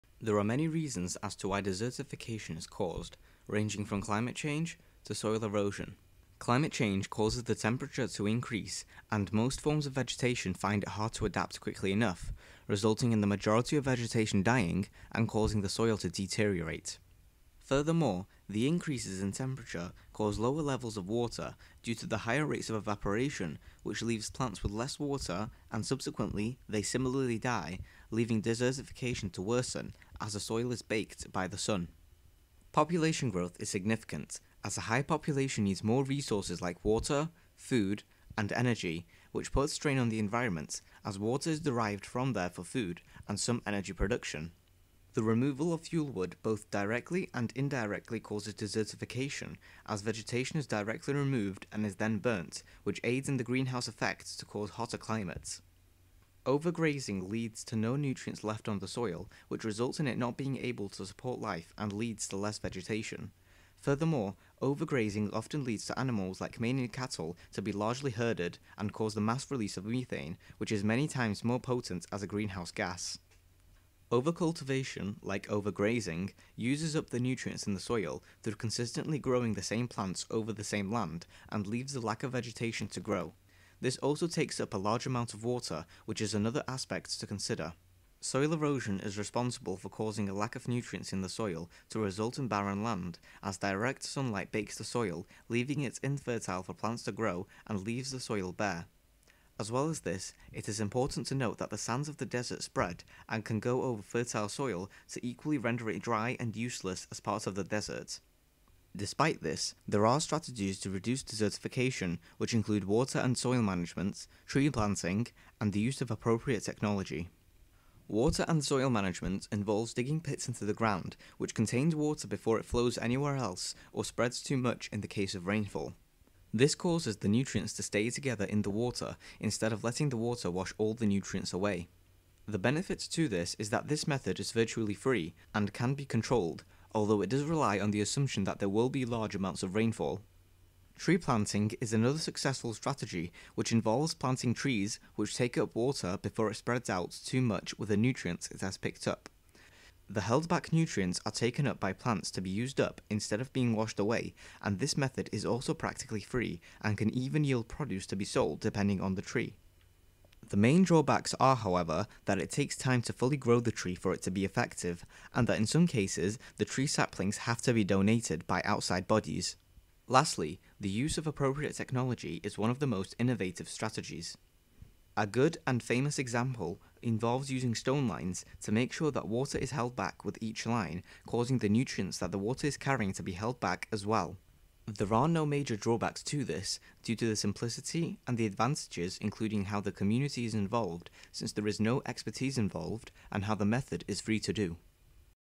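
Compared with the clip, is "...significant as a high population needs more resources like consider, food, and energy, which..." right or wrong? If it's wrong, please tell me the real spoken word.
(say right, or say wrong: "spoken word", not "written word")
wrong: "water", not "consider".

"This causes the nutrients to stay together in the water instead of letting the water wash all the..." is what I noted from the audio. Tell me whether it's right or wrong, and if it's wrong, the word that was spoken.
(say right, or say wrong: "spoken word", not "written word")
right.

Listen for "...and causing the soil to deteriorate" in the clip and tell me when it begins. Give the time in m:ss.
0:15.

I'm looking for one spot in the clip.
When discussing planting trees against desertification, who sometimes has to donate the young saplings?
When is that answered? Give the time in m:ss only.
2:48.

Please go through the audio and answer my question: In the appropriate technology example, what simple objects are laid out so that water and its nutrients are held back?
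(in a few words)
Stone lines.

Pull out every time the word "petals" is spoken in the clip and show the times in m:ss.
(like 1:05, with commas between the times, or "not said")
not said.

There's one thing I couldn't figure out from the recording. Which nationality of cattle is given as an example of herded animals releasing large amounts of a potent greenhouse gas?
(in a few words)
Canadian.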